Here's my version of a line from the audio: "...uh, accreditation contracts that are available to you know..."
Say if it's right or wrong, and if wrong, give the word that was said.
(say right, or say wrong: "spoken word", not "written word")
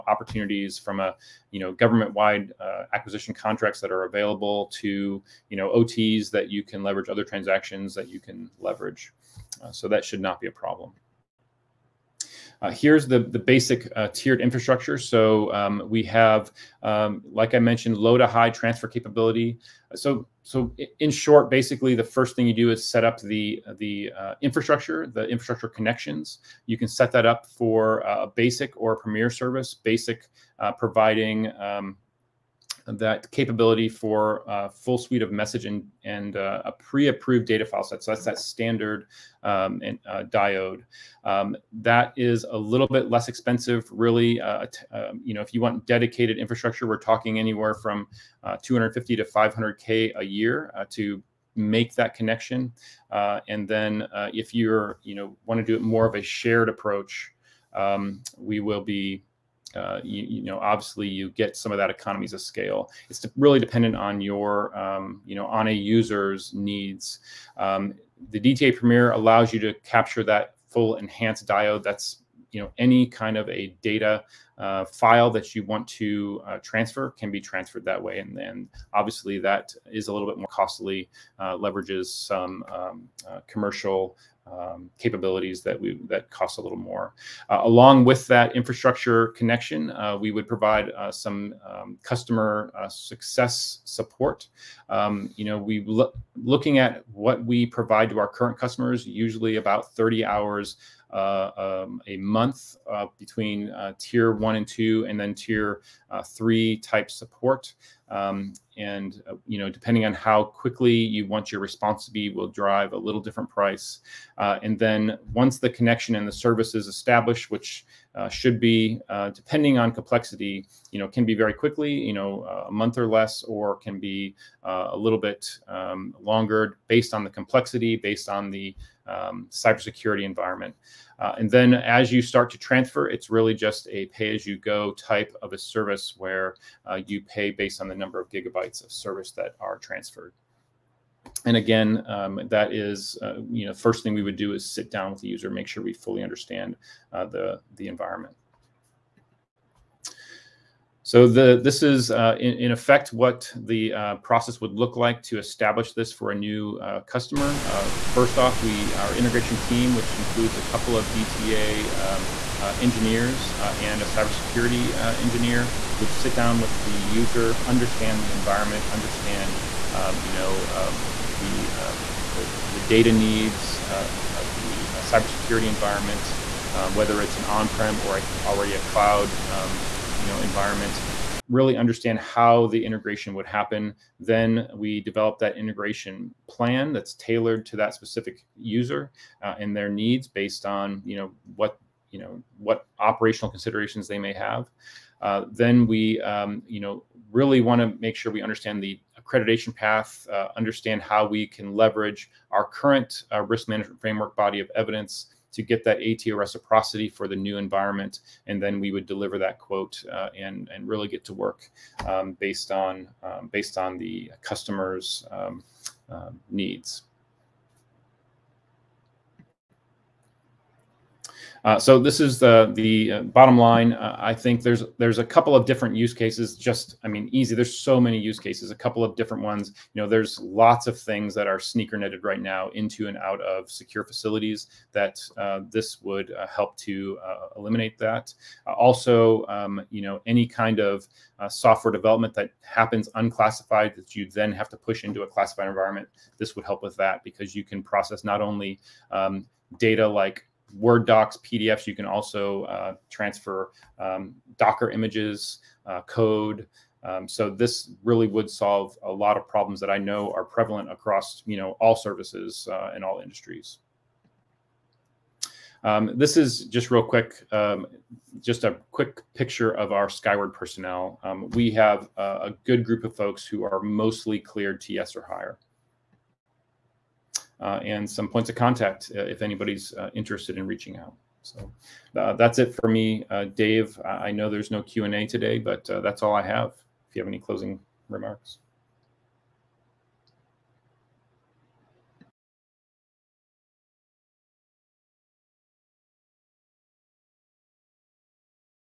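wrong: "acquisition", not "accreditation".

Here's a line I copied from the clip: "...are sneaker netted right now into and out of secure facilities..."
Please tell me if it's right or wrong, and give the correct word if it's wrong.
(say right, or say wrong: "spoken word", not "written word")
right.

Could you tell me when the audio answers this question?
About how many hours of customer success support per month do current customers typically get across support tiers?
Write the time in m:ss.
1:39.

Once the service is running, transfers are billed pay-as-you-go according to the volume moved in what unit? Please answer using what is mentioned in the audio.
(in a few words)
gigabytes.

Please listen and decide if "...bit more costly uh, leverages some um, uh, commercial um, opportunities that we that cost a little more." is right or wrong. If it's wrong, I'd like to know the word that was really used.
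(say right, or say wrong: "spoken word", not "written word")
wrong: "capabilities", not "opportunities".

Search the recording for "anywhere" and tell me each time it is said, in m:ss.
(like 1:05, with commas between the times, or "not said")
0:47.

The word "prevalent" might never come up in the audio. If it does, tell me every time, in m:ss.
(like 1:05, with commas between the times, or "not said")
4:20.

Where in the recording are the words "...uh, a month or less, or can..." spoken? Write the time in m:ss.
2:02.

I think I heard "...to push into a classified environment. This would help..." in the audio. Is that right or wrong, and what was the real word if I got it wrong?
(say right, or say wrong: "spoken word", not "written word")
right.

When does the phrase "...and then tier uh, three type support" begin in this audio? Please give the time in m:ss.
1:45.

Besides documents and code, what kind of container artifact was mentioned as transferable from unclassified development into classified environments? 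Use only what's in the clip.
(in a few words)
Docker images.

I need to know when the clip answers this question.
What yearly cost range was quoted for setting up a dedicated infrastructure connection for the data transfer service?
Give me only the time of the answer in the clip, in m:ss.
0:48.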